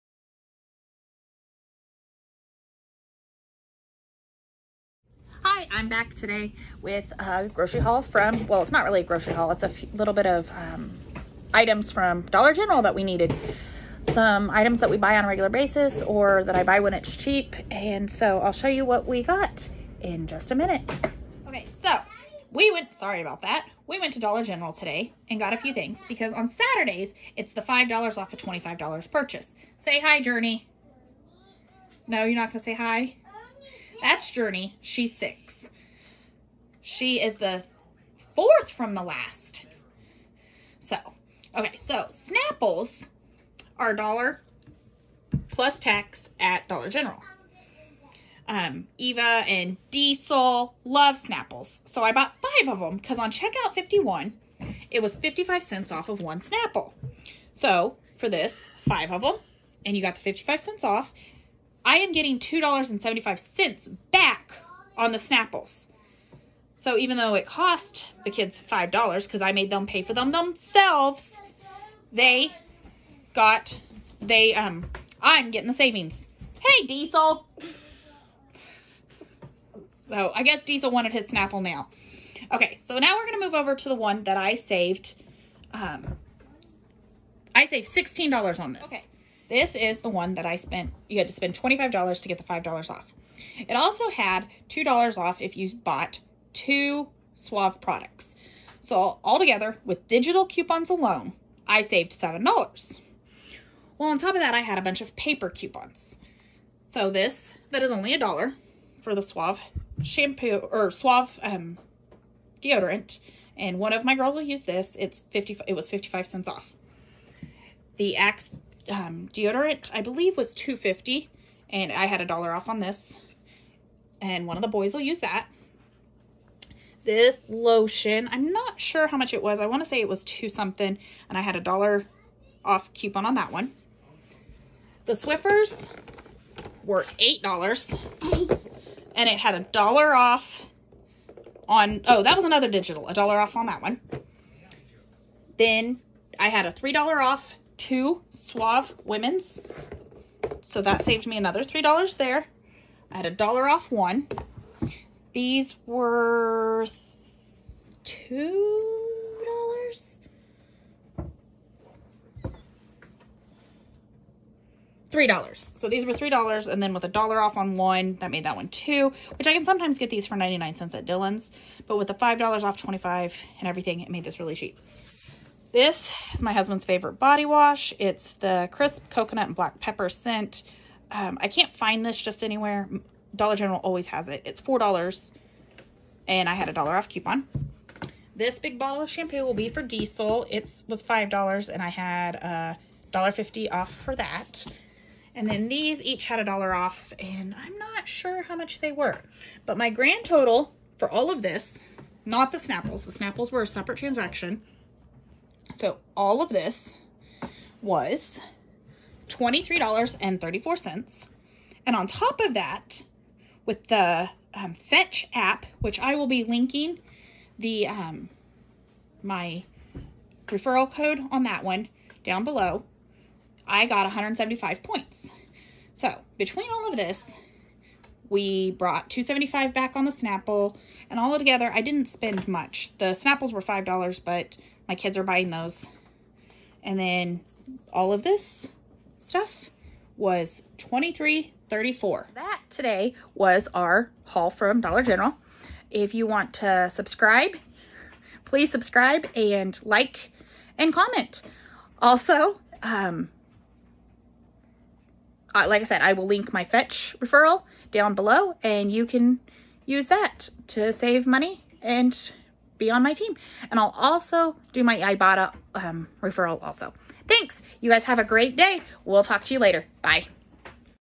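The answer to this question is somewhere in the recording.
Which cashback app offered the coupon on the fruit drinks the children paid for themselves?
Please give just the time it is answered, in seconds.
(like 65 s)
53 s.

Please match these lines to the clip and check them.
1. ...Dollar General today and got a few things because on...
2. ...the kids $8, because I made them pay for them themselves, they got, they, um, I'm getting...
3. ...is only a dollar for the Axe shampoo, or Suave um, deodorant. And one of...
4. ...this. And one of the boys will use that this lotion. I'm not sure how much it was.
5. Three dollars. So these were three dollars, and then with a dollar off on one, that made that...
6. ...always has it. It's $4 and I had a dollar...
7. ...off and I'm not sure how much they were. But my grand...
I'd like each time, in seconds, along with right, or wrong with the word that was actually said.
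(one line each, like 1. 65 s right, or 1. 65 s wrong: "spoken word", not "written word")
1. 24 s right
2. 68 s wrong: "5", not "8"
3. 107 s wrong: "Suave", not "Axe"
4. 122 s right
5. 165 s right
6. 183 s right
7. 196 s right.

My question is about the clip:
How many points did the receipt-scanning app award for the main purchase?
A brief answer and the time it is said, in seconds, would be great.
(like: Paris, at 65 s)
175, at 224 s.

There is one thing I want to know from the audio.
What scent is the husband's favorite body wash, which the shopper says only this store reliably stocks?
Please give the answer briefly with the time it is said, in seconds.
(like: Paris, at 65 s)
crisp coconut and black pepper, at 178 s.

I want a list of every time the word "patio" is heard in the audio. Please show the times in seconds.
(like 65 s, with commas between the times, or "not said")
not said.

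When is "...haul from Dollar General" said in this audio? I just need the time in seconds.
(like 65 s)
244 s.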